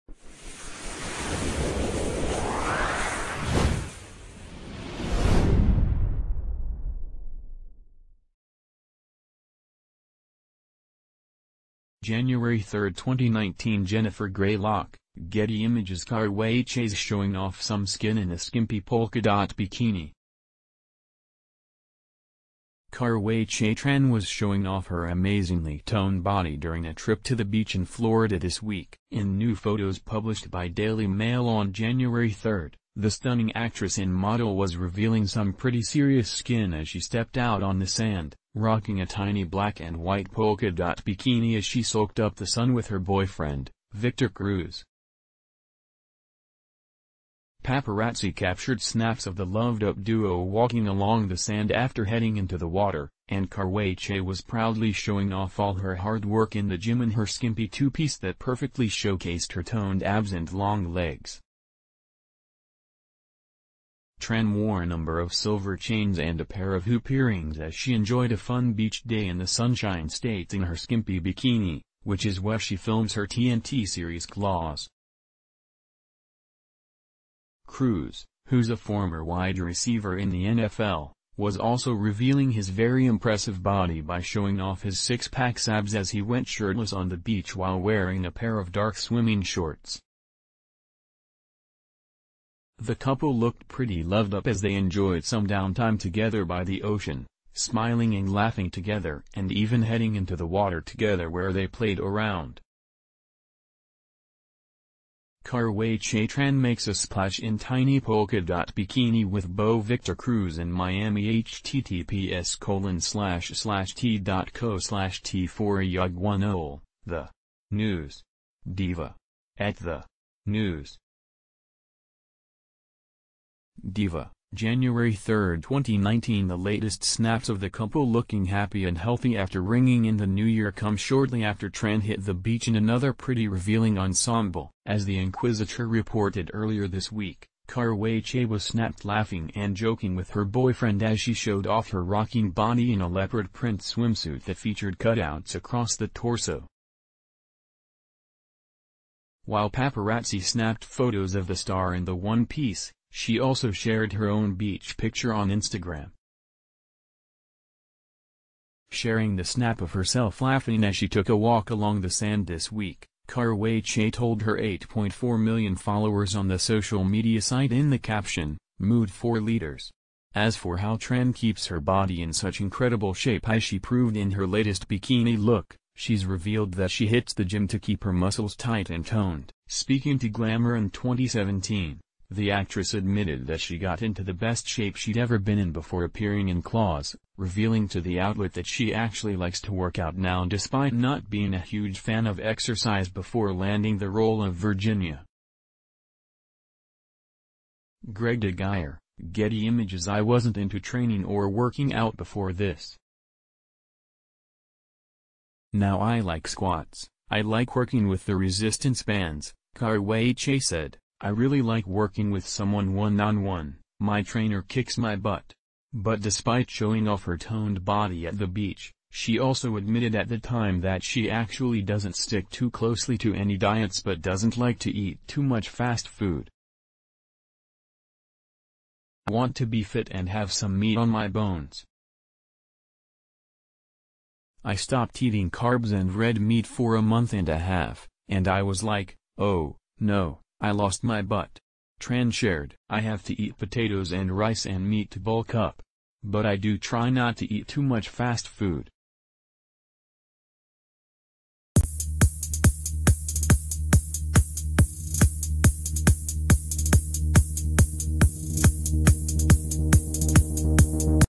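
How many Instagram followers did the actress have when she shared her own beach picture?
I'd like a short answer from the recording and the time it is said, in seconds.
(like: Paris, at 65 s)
8.4 million, at 164 s.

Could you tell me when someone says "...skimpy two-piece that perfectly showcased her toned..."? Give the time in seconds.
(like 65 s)
57 s.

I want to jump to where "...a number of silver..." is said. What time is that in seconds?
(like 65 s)
64 s.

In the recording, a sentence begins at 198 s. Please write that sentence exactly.
Greg DeGuire, Getty Images I wasn't into training or working out before this.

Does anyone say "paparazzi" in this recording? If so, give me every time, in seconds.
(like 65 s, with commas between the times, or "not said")
47 s, 149 s.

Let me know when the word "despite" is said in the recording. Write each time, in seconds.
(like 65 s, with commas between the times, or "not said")
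190 s, 216 s.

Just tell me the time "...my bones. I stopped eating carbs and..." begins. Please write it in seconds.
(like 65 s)
231 s.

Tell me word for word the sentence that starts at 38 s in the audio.
Rocking a tiny black and white polka dot bikini as she soaked up the sun with her boyfriend, Victor Cruz.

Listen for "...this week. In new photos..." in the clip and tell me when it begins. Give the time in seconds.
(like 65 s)
28 s.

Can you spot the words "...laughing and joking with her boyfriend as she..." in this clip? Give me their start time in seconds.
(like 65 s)
139 s.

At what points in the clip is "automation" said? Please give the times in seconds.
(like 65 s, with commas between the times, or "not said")
not said.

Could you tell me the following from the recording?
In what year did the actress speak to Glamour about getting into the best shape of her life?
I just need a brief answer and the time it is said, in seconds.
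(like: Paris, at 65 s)
2017, at 180 s.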